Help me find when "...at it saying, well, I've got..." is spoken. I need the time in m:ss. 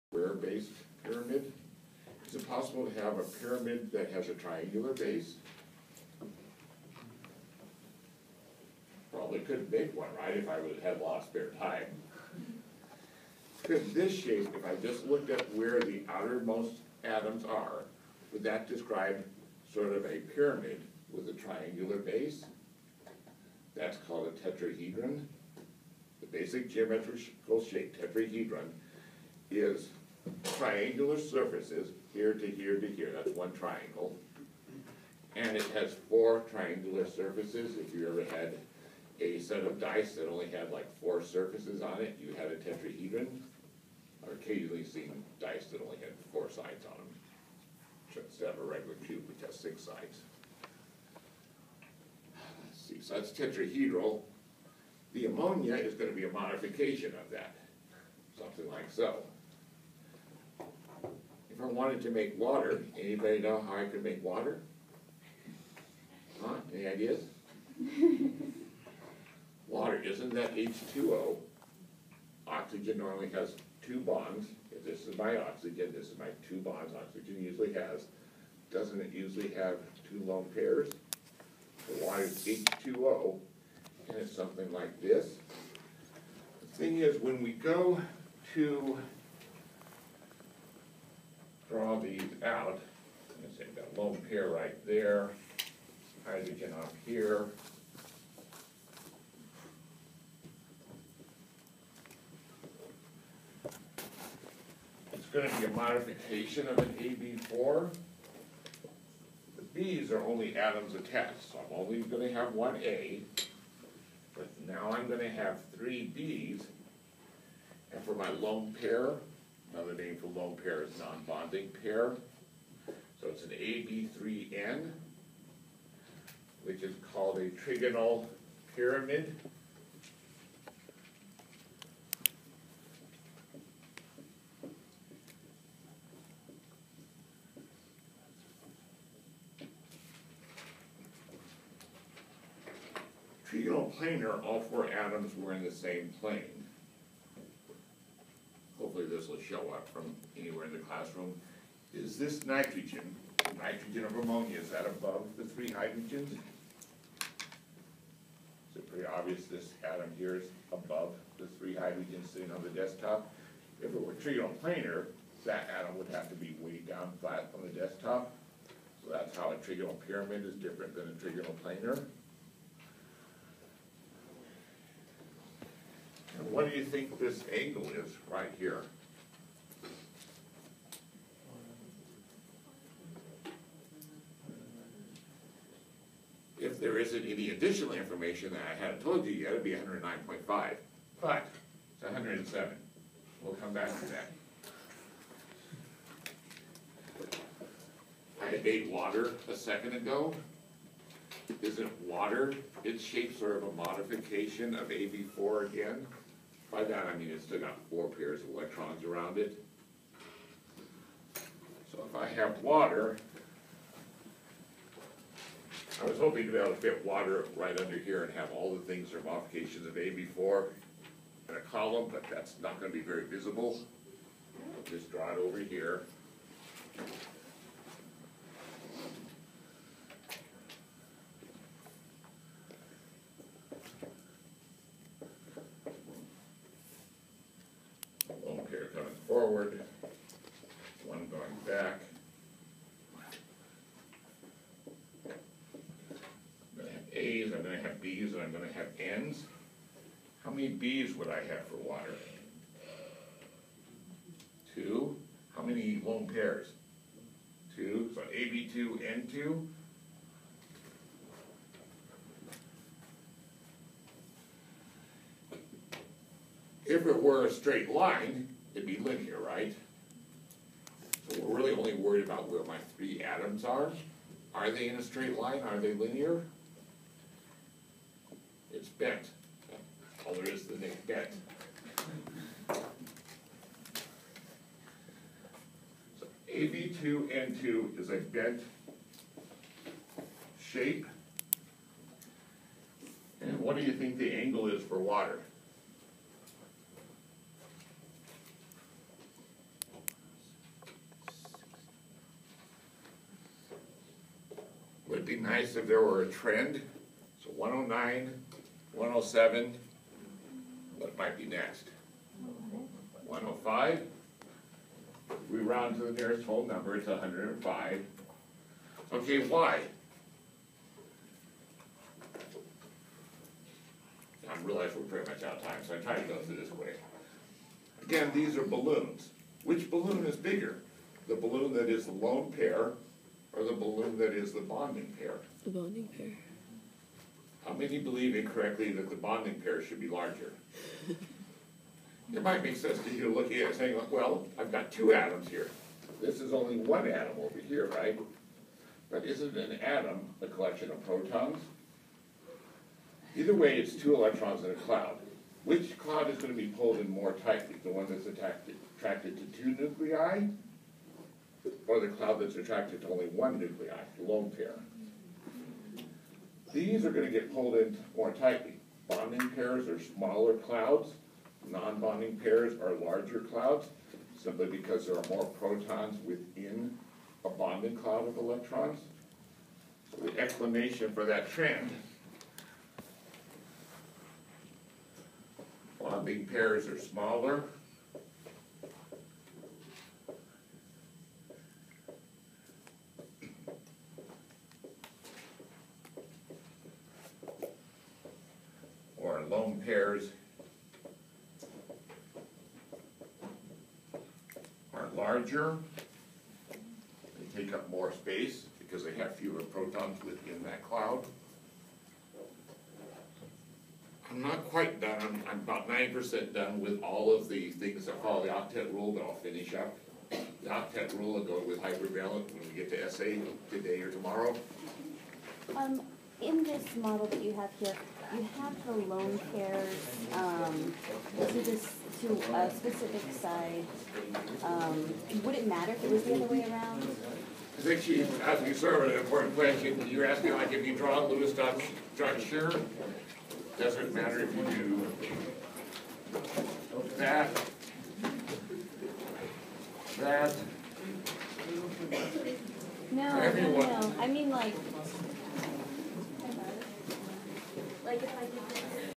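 5:43.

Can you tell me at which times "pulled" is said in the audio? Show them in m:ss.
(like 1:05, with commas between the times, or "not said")
5:56, 6:07.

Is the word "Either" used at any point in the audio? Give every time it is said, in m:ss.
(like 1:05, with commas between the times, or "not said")
5:53.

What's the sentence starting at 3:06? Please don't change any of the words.
there isn't any additional information that I hadn't told you yet, it'd be 109.5.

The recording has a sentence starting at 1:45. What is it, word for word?
It's going to be a modification of an AB4.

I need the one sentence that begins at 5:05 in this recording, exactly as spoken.
Would it be nice if there were a trend.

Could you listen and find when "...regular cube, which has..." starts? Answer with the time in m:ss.
0:48.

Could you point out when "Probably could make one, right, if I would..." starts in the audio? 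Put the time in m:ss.
0:09.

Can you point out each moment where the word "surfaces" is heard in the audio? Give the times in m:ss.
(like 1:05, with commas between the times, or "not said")
0:31, 0:37, 0:41.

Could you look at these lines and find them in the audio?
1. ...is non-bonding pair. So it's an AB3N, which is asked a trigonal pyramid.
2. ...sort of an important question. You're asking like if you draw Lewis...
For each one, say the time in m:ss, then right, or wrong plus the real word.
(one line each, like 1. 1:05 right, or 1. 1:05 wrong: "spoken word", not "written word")
1. 2:00 wrong: "called", not "asked"
2. 7:18 right.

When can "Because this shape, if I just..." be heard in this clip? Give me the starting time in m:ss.
0:13.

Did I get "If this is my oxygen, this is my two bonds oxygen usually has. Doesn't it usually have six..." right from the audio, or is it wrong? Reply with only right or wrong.
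wrong.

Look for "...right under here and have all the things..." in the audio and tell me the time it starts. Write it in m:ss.
3:37.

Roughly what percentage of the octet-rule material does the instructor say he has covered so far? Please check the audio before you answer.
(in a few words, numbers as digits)
90%.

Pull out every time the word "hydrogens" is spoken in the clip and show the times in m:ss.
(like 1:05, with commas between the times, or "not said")
1:36, 2:35, 2:41.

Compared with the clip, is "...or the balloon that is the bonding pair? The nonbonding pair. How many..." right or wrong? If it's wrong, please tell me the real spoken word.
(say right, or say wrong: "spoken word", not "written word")
wrong: "bonding", not "nonbonding".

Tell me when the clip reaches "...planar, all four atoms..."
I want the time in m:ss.
2:23.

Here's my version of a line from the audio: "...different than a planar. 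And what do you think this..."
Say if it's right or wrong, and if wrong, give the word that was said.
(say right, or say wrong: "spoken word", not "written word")
right.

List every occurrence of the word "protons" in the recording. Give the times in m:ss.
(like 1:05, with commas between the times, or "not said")
5:51, 6:15, 6:49.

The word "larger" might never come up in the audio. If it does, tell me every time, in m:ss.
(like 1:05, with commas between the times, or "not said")
5:40, 6:13, 6:45.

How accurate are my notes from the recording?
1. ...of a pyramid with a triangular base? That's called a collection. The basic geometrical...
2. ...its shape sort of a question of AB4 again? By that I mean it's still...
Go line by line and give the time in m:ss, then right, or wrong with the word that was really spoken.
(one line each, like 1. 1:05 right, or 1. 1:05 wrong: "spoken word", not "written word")
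1. 0:19 wrong: "tetrahedron", not "collection"
2. 3:22 wrong: "modification", not "question".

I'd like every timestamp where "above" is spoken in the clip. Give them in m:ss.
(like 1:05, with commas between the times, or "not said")
2:34, 2:40.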